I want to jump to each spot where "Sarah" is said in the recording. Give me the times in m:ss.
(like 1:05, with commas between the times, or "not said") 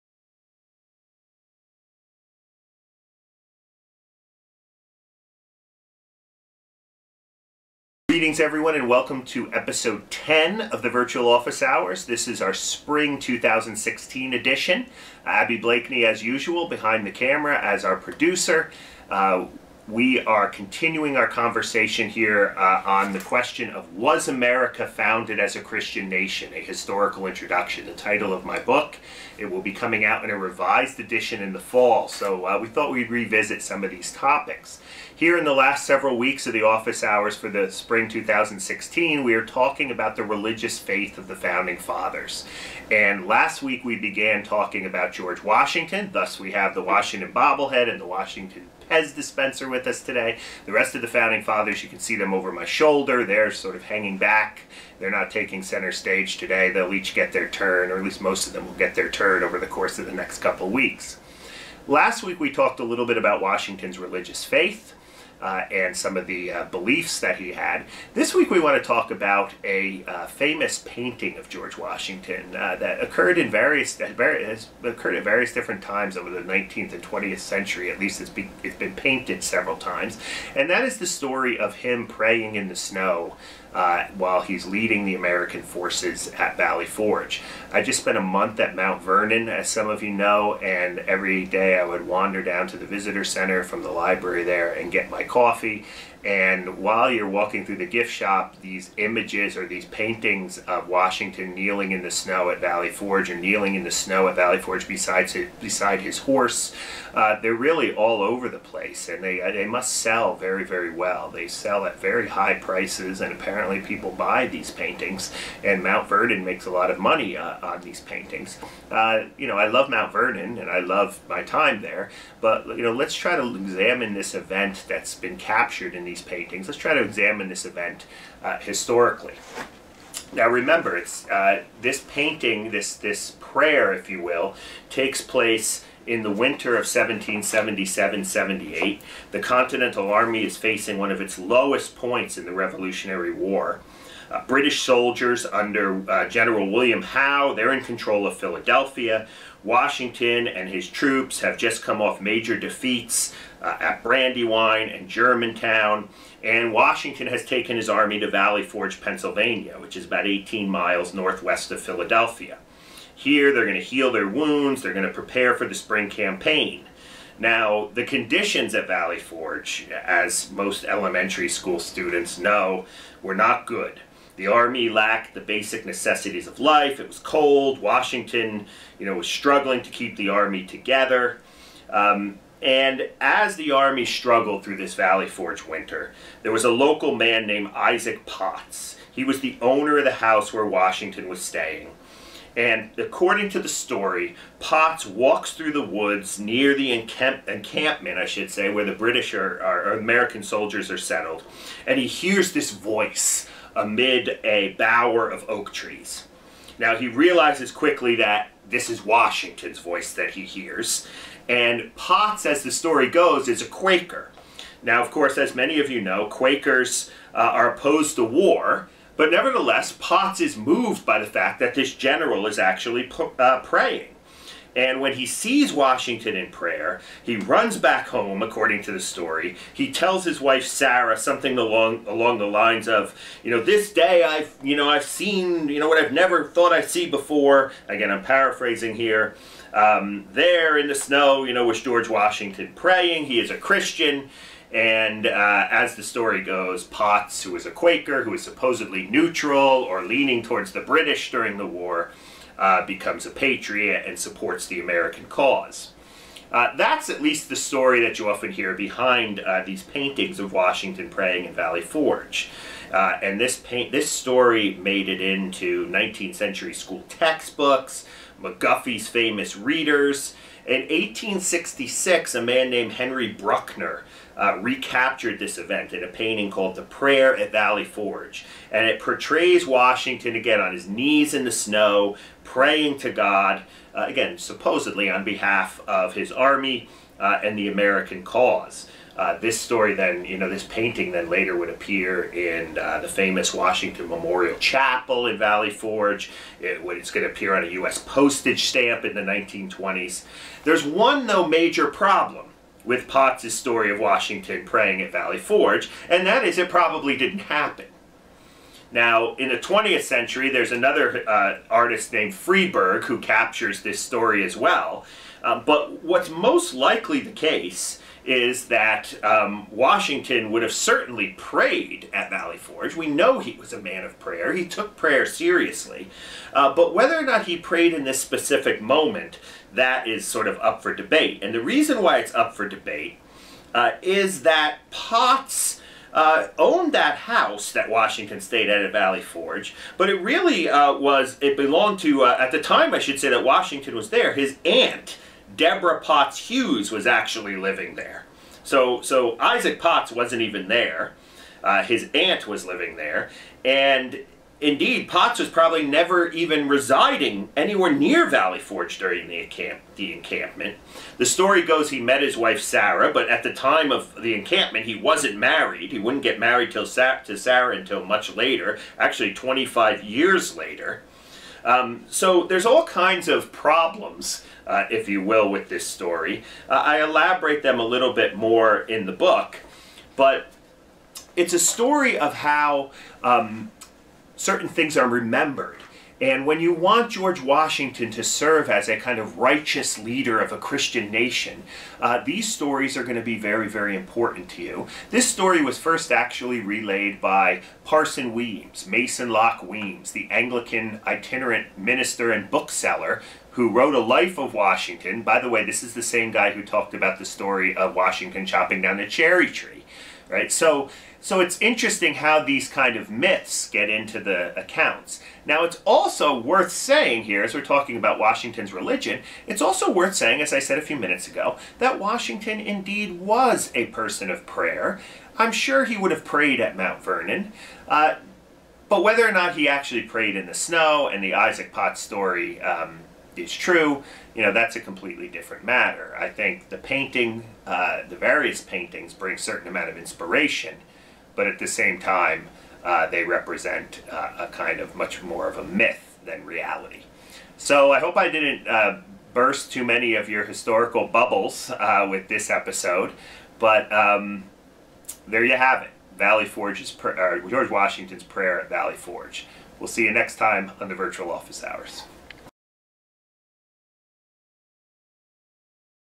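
3:50, 6:02, 6:07.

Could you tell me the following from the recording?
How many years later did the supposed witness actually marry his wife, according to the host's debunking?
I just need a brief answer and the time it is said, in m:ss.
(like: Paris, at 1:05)
25, at 6:09.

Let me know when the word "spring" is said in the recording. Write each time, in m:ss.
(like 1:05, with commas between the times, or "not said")
0:12, 0:37, 2:45.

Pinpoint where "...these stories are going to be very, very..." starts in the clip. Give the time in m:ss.
6:32.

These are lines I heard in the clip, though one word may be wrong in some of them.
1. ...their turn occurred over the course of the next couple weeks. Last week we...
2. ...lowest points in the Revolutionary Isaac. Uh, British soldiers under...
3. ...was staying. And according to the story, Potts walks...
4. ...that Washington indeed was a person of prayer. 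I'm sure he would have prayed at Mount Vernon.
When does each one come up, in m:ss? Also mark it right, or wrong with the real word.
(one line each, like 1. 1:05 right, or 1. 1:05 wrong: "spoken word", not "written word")
1. 0:58 right
2. 2:21 wrong: "War", not "Isaac"
3. 3:11 right
4. 7:01 right.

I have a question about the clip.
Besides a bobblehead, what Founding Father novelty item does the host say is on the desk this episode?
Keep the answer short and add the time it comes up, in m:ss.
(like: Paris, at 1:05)
Pez dispenser, at 0:48.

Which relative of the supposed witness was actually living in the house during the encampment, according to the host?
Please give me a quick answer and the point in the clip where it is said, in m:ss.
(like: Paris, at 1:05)
Deborah Potts Hewes, at 5:45.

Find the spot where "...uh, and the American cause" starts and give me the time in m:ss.
4:47.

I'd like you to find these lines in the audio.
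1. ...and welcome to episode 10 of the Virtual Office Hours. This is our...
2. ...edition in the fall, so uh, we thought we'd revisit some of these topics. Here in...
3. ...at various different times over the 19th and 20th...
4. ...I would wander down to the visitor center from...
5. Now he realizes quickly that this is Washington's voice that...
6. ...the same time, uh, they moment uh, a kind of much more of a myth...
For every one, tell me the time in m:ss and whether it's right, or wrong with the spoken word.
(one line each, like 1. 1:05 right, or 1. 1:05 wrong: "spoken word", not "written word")
1. 0:08 right
2. 0:30 right
3. 1:15 right
4. 1:31 right
5. 3:26 right
6. 7:21 wrong: "represent", not "moment".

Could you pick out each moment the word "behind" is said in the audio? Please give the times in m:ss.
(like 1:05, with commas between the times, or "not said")
0:16, 4:18.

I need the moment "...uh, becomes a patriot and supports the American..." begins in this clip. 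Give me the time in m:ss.
4:12.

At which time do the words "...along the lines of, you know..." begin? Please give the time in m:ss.
3:52.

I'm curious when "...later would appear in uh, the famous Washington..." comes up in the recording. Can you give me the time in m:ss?
4:51.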